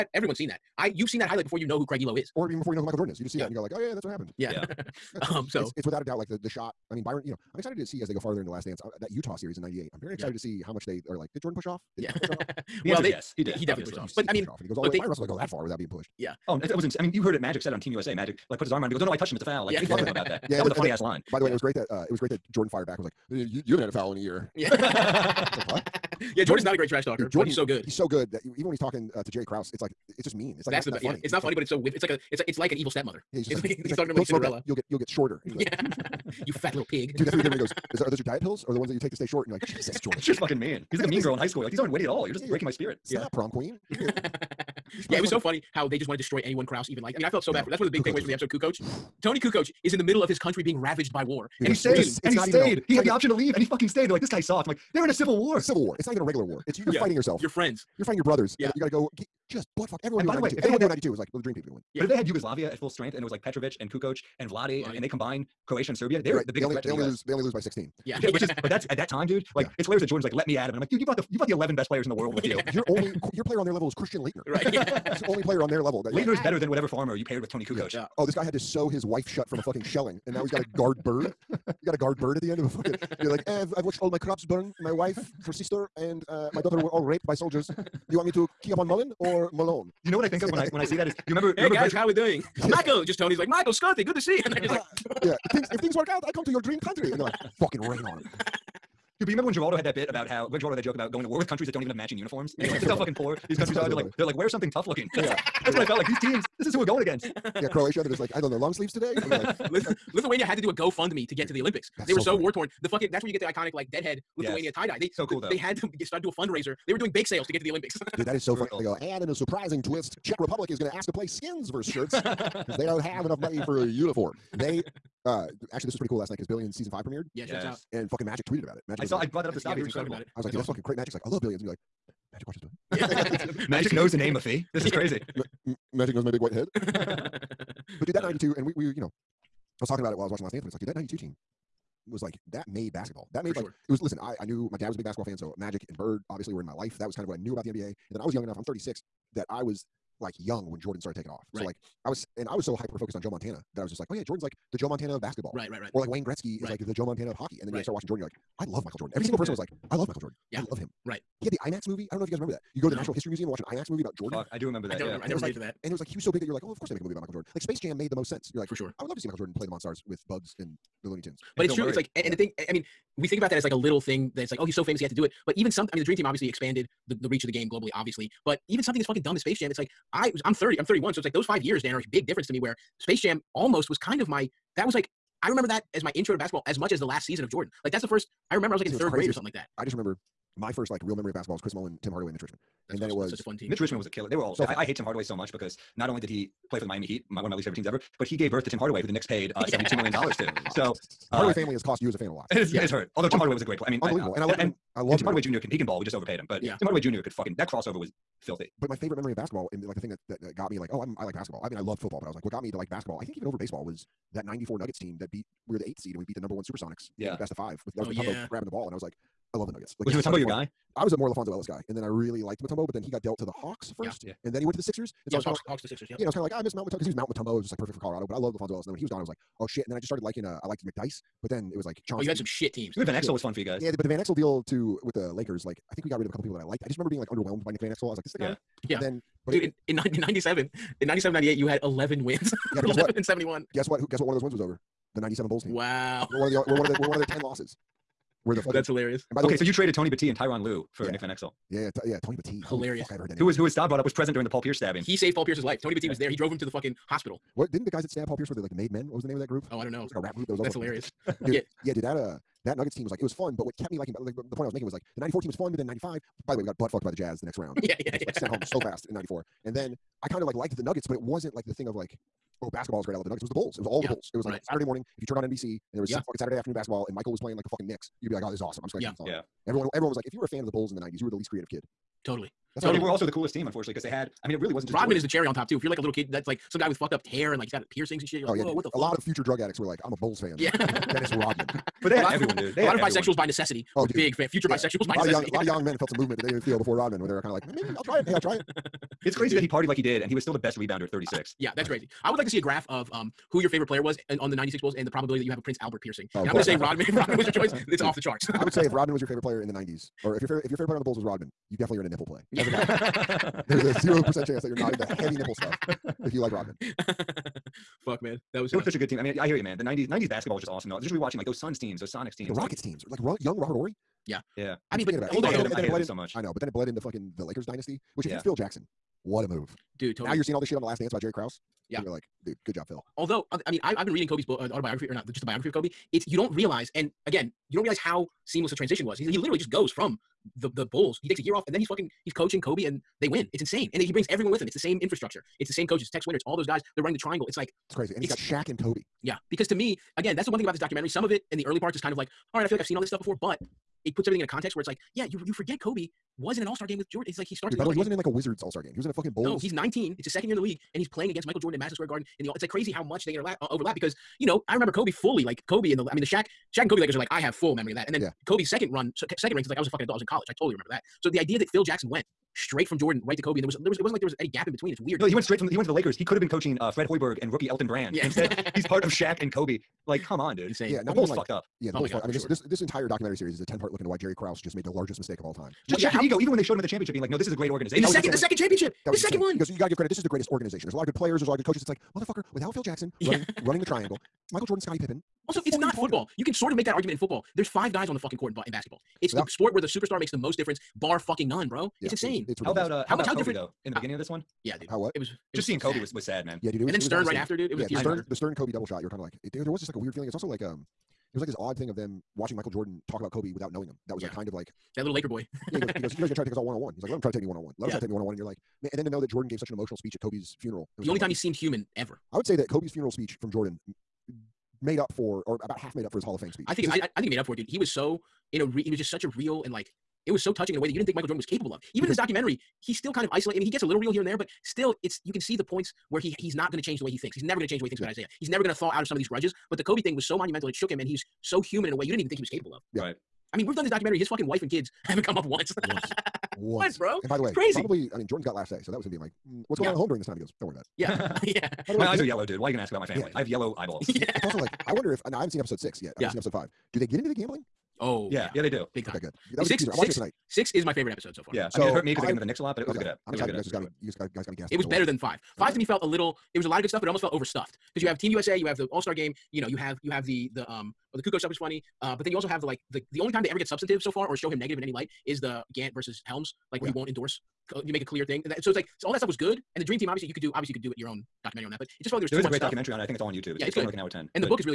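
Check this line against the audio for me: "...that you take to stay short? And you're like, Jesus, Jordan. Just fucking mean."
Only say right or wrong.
right.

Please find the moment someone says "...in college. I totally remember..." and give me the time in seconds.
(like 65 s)
370 s.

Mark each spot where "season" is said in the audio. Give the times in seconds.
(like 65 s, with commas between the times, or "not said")
126 s, 187 s.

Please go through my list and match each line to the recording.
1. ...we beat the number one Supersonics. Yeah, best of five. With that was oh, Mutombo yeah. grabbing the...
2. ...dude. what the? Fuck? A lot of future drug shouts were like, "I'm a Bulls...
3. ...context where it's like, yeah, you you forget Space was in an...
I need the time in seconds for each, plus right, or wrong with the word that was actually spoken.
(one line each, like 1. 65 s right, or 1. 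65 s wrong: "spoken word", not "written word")
1. 216 s right
2. 288 s wrong: "addicts", not "shouts"
3. 354 s wrong: "Kobe", not "Space".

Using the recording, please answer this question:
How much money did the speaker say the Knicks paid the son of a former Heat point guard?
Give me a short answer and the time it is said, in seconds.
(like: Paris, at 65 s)
$72 million, at 199 s.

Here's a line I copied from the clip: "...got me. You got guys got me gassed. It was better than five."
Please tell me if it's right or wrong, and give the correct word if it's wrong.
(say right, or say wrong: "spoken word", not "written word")
right.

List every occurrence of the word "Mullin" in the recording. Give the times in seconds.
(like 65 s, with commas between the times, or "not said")
88 s, 191 s.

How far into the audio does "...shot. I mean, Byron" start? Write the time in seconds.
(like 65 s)
6 s.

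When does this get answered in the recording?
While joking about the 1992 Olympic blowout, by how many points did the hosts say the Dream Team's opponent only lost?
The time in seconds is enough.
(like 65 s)
67 s.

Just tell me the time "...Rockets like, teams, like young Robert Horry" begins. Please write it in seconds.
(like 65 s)
322 s.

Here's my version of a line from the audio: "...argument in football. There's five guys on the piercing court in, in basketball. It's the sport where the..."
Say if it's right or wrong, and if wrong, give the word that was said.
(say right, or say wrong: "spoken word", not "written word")
wrong: "fucking", not "piercing".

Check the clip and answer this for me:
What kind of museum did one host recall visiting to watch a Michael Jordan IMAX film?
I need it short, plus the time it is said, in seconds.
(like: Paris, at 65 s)
Natural History Museum, at 163 s.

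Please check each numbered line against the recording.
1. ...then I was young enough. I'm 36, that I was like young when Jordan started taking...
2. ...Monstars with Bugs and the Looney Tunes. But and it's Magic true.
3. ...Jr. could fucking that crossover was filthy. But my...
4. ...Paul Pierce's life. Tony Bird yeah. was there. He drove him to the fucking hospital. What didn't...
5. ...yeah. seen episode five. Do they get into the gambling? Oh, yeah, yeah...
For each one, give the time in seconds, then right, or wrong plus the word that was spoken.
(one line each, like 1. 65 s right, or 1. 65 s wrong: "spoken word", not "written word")
1. 148 s right
2. 169 s wrong: "Bill", not "Magic"
3. 206 s right
4. 255 s wrong: "Battie", not "Bird"
5. 456 s right.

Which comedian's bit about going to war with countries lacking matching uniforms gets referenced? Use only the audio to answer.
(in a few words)
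Greg Giraldo.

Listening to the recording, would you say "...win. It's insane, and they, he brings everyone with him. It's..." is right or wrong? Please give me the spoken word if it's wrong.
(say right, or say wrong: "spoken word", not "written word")
right.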